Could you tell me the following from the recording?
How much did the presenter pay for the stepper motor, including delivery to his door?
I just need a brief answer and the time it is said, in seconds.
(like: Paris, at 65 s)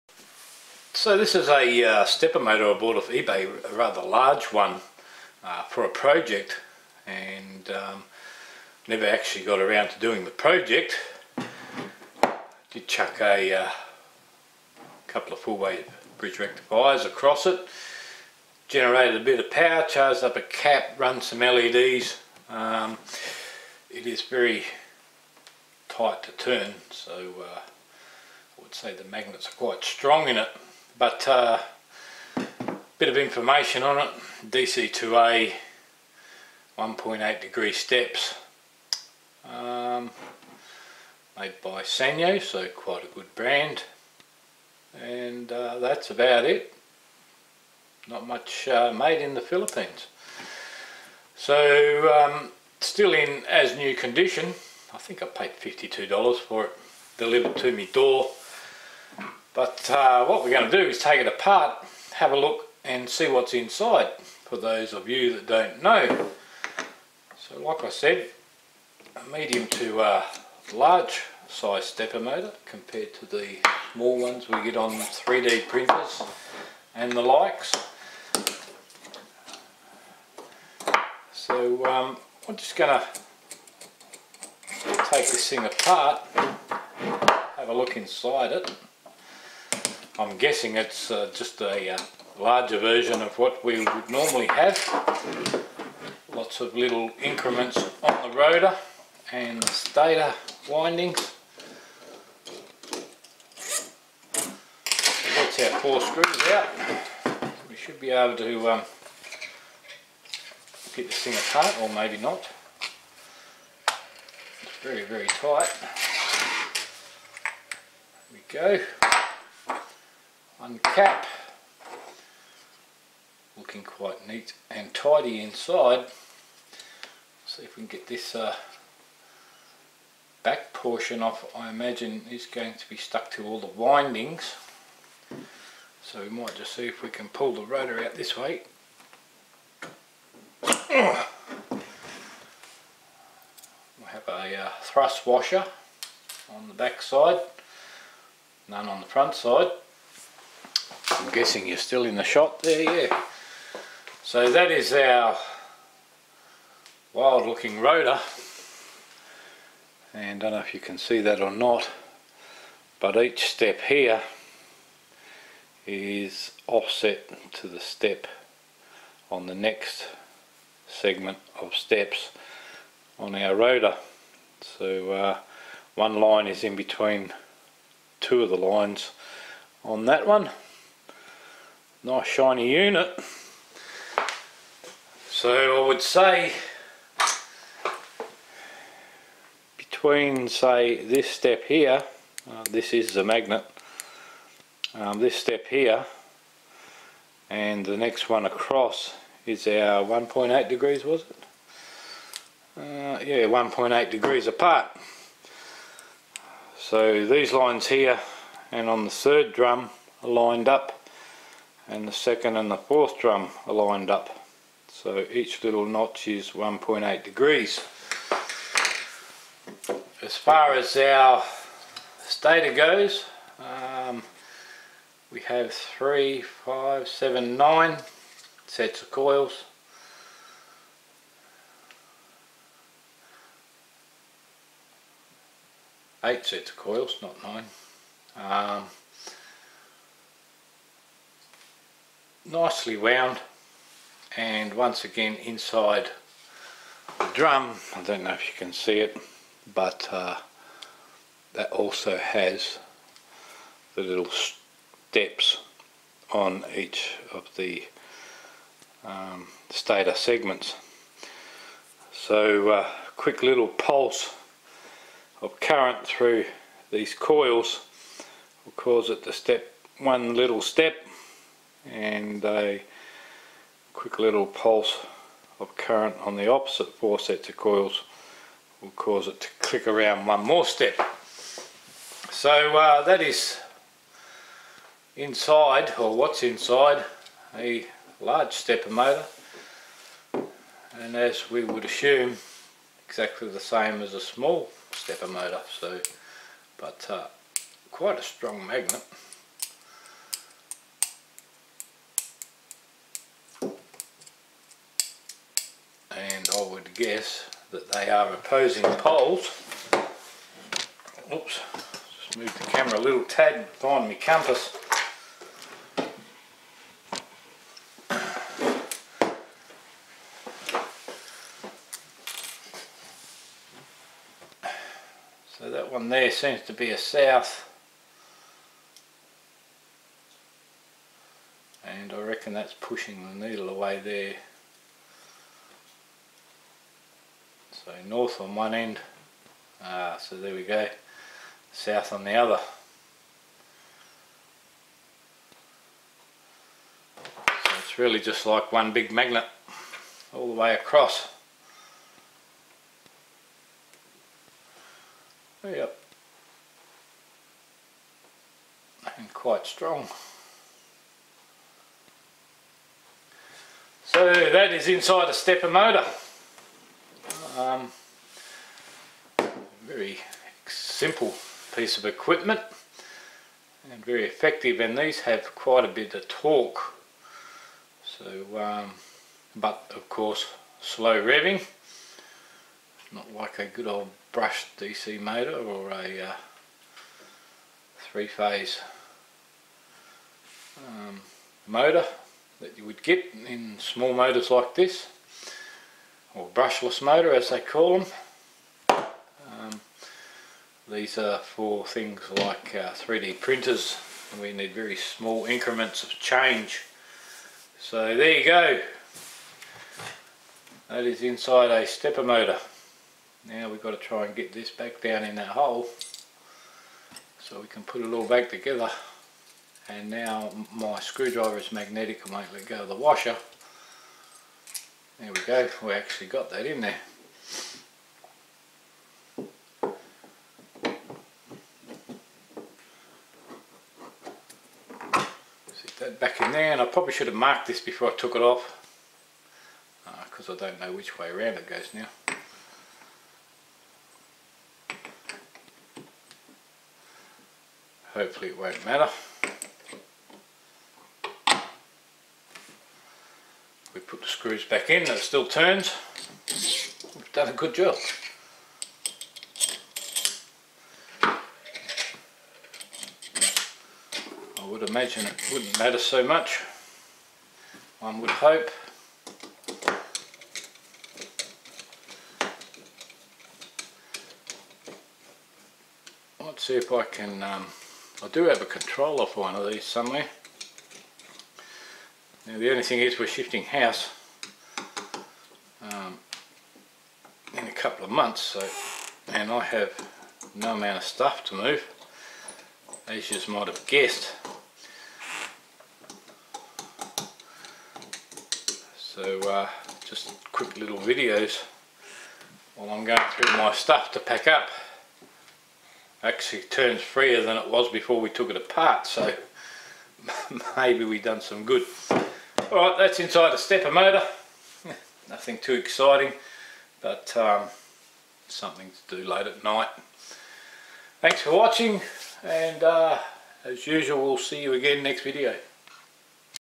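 $52, at 55 s.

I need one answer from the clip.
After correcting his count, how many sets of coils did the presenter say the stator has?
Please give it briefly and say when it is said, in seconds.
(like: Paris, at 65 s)
8, at 236 s.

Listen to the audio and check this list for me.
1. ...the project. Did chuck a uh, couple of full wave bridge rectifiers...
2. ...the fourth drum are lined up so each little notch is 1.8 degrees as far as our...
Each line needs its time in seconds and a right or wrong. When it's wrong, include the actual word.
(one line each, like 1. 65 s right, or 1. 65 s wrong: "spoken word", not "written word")
1. 10 s right
2. 212 s right.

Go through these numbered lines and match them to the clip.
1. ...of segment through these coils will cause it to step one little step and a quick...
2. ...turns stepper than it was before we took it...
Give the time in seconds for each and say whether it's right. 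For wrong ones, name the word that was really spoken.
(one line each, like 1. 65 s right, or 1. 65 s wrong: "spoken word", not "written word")
1. 265 s wrong: "current", not "segment"
2. 506 s wrong: "freer", not "stepper".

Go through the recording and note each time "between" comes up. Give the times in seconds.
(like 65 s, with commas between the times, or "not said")
176 s, 189 s.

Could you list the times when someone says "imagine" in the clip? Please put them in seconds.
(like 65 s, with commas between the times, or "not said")
131 s, 464 s.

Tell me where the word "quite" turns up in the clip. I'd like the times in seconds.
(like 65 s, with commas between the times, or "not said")
29 s, 42 s, 123 s, 297 s, 359 s, 375 s.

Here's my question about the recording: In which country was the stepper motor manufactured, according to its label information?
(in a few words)
the Philippines.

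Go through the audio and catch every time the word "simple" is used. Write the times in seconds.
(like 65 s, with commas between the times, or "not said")
370 s.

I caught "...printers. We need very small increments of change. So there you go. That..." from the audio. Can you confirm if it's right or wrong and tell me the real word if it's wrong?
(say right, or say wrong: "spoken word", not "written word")
right.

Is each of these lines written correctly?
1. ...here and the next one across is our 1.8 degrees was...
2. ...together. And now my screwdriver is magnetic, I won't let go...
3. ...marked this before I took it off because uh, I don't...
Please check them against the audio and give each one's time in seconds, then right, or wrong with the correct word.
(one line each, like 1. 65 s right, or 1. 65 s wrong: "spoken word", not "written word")
1. 195 s right
2. 418 s right
3. 437 s right.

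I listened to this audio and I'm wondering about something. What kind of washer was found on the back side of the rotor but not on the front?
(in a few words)
thrust washer.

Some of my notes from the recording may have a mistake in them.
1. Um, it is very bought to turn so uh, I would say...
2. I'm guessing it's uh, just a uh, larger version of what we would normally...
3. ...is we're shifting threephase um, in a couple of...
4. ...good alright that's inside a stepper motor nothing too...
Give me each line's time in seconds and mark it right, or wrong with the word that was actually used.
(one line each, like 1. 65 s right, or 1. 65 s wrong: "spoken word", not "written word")
1. 22 s wrong: "tight", not "bought"
2. 90 s right
3. 483 s wrong: "house", not "threephase"
4. 511 s right.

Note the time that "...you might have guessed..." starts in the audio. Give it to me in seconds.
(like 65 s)
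493 s.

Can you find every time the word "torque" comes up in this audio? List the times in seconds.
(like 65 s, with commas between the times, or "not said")
376 s.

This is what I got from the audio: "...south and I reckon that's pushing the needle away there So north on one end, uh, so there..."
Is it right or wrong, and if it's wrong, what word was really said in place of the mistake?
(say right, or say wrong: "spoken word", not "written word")
right.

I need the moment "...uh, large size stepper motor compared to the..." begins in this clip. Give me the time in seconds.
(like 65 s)
69 s.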